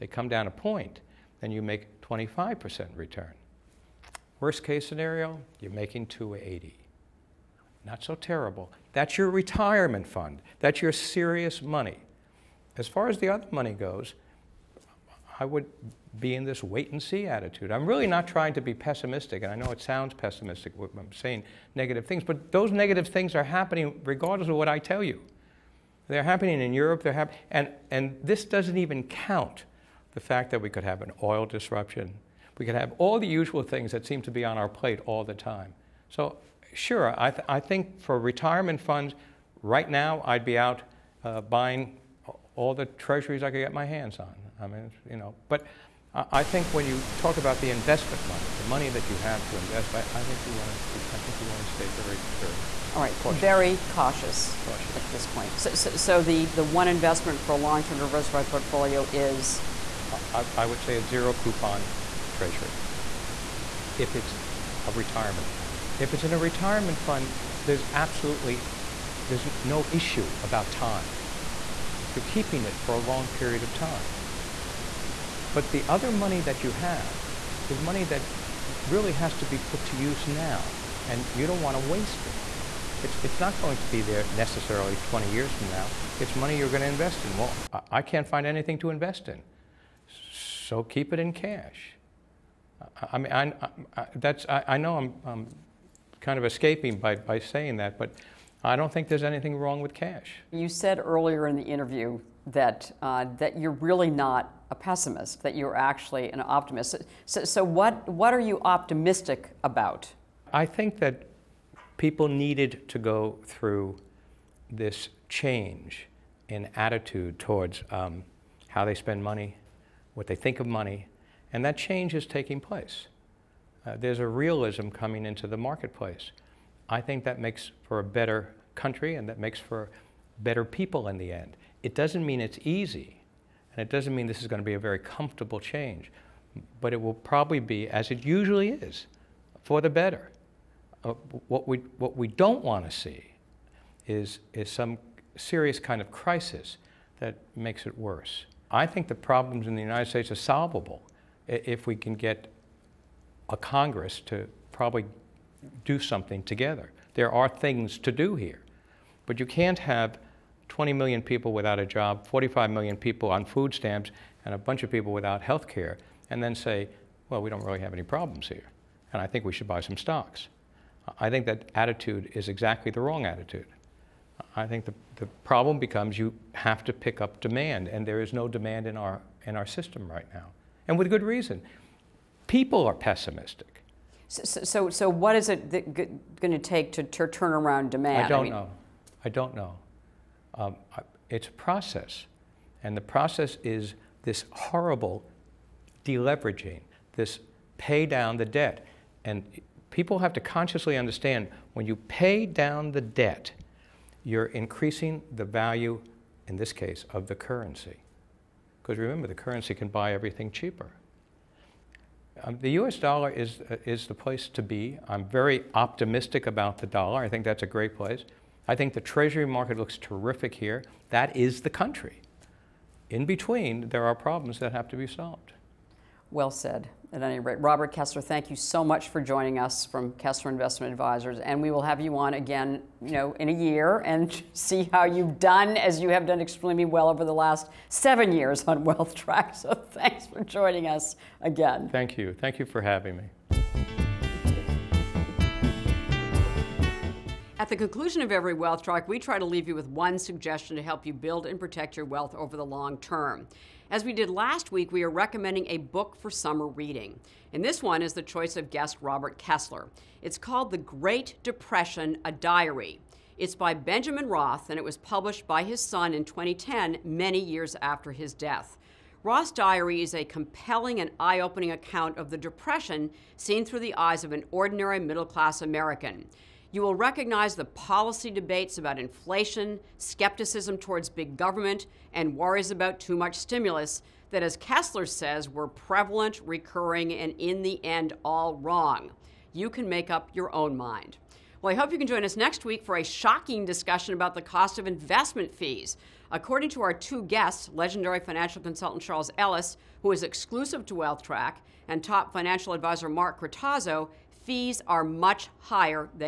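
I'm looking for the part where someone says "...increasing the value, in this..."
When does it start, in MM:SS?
03:24.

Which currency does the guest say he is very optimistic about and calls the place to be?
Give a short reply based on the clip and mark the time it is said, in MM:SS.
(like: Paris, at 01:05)
US dollar, at 03:32.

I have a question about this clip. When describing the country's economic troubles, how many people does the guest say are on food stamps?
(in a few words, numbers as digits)
45 million.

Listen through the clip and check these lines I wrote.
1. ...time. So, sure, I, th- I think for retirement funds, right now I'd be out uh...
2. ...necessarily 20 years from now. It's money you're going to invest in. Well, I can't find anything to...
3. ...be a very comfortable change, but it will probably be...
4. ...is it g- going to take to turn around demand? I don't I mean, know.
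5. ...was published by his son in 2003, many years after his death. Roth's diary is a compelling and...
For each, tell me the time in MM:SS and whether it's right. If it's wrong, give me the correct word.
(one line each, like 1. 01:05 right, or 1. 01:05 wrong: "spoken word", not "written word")
1. 00:35 right
2. 01:24 right
3. 02:14 right
4. 03:05 right
5. 04:24 wrong: "2010", not "2003".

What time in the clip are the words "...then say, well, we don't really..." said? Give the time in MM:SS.
02:46.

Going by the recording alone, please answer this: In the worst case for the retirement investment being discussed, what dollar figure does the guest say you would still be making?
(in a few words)
280.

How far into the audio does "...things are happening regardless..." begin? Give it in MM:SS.
00:23.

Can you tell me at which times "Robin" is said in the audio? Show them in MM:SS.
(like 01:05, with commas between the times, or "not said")
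not said.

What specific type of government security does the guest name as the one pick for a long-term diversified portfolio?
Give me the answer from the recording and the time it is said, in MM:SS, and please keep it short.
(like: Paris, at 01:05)
zero coupon treasury, at 01:01.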